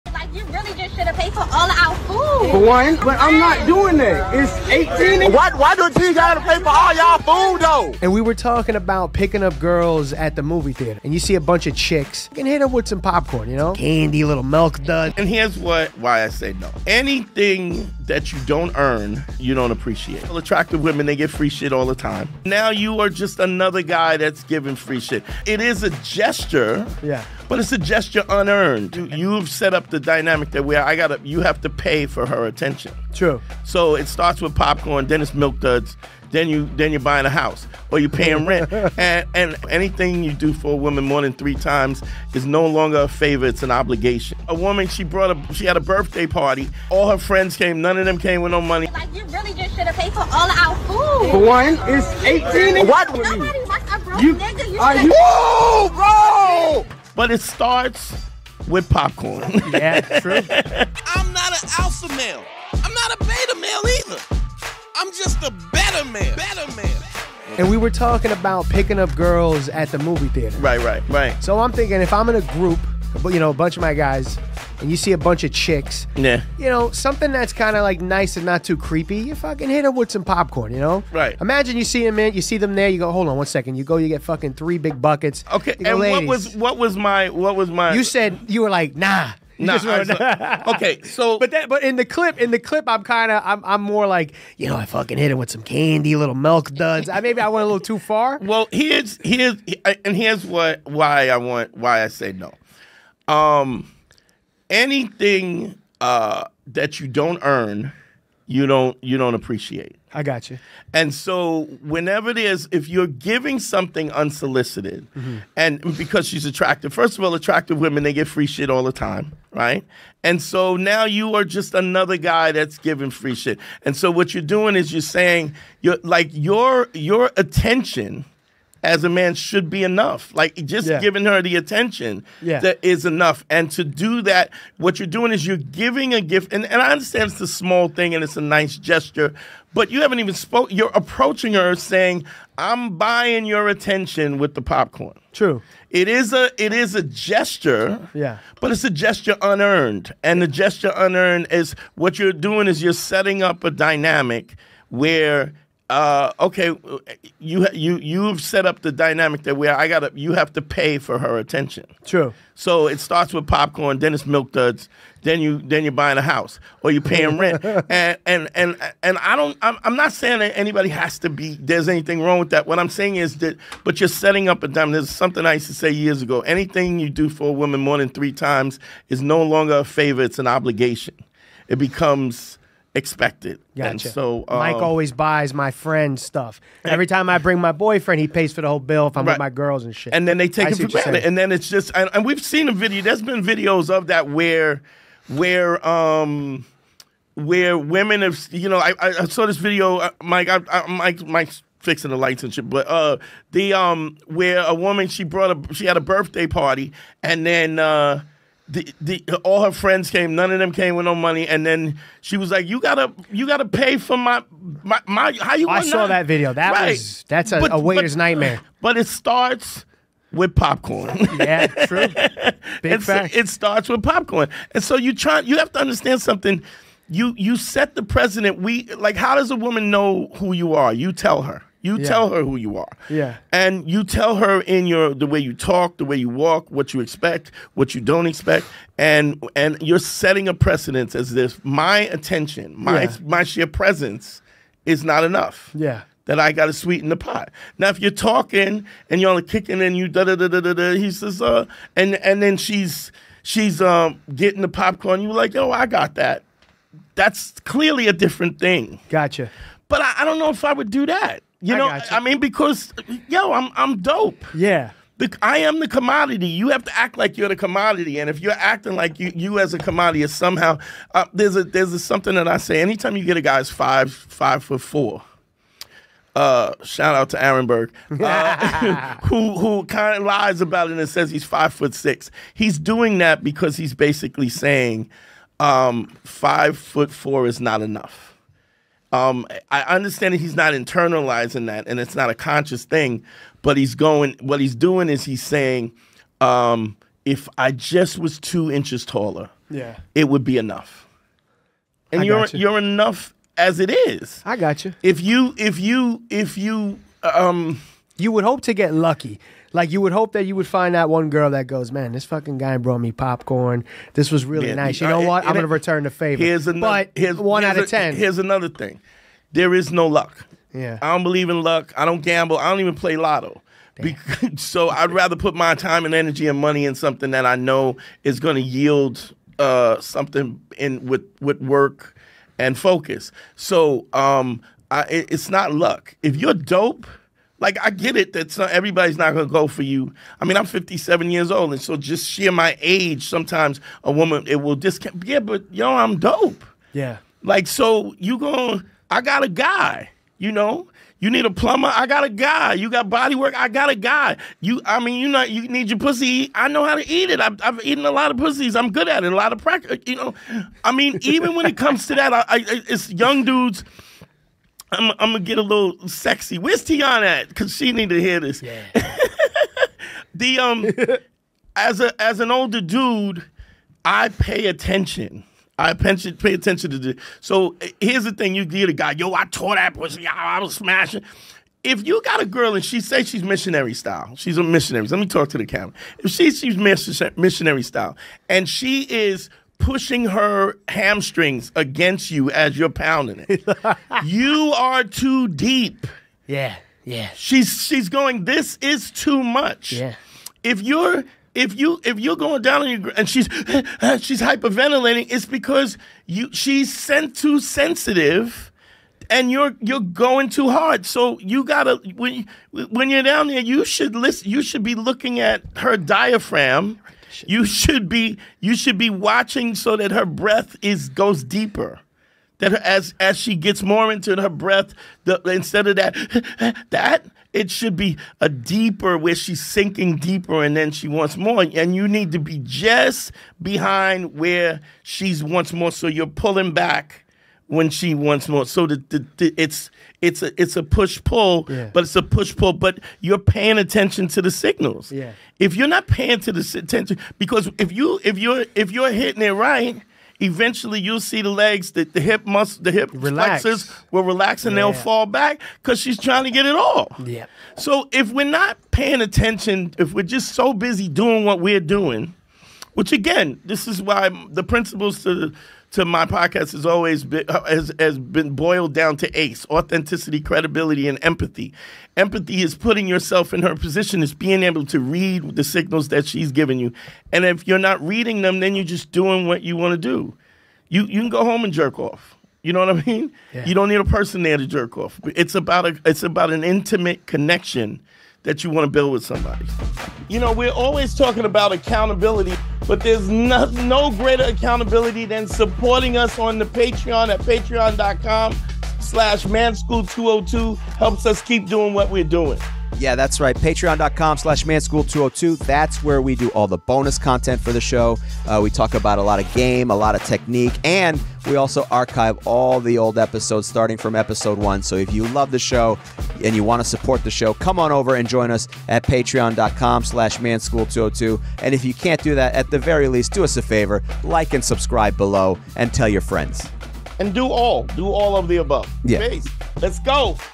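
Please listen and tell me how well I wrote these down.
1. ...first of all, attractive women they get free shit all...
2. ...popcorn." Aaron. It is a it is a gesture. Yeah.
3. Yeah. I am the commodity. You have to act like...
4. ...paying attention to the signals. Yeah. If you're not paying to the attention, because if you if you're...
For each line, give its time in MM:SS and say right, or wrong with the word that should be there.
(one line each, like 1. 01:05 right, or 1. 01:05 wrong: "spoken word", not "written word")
1. 01:56 right
2. 02:24 wrong: "True", not "Aaron"
3. 04:24 right
4. 07:23 right.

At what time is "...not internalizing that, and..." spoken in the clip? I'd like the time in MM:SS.
04:50.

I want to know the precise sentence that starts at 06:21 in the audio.
If you got a girl and she say she's missionary style, she's a missionary.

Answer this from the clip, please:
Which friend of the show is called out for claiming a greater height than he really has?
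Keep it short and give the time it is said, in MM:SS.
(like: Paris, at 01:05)
Aaron, at 04:37.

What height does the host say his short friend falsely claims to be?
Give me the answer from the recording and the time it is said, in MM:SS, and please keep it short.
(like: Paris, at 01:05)
5 foot 6, at 04:41.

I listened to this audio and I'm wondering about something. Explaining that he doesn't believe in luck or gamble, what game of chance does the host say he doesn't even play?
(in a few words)
lotto.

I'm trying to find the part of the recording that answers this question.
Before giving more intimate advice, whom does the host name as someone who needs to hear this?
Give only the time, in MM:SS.
06:06.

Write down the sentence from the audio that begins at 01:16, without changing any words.
you know, something that's kind of like nice and not too creepy, you fucking hit her with some popcorn, you know?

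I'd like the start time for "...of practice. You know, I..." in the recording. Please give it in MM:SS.
05:59.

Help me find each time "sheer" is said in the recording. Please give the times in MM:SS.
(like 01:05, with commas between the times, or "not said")
04:03, 05:42.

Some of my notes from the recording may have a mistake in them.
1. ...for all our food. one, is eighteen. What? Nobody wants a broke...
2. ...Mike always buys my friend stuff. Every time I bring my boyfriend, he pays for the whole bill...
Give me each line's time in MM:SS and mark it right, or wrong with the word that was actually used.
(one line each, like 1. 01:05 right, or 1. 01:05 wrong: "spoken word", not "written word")
1. 00:50 right
2. 03:04 right.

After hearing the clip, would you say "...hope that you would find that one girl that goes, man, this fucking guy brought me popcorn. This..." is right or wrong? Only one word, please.
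right.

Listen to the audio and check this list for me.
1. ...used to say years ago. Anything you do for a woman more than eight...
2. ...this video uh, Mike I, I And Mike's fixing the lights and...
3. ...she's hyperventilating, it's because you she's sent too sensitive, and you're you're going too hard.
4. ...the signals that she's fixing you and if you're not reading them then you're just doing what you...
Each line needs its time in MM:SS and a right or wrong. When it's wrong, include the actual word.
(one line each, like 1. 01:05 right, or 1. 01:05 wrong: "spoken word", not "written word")
1. 02:55 wrong: "three", not "eight"
2. 03:19 wrong: "Mike", not "And"
3. 06:44 right
4. 07:55 wrong: "giving", not "fixing".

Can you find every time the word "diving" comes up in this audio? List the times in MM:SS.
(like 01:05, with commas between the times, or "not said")
not said.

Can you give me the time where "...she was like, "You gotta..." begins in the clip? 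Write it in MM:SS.
03:32.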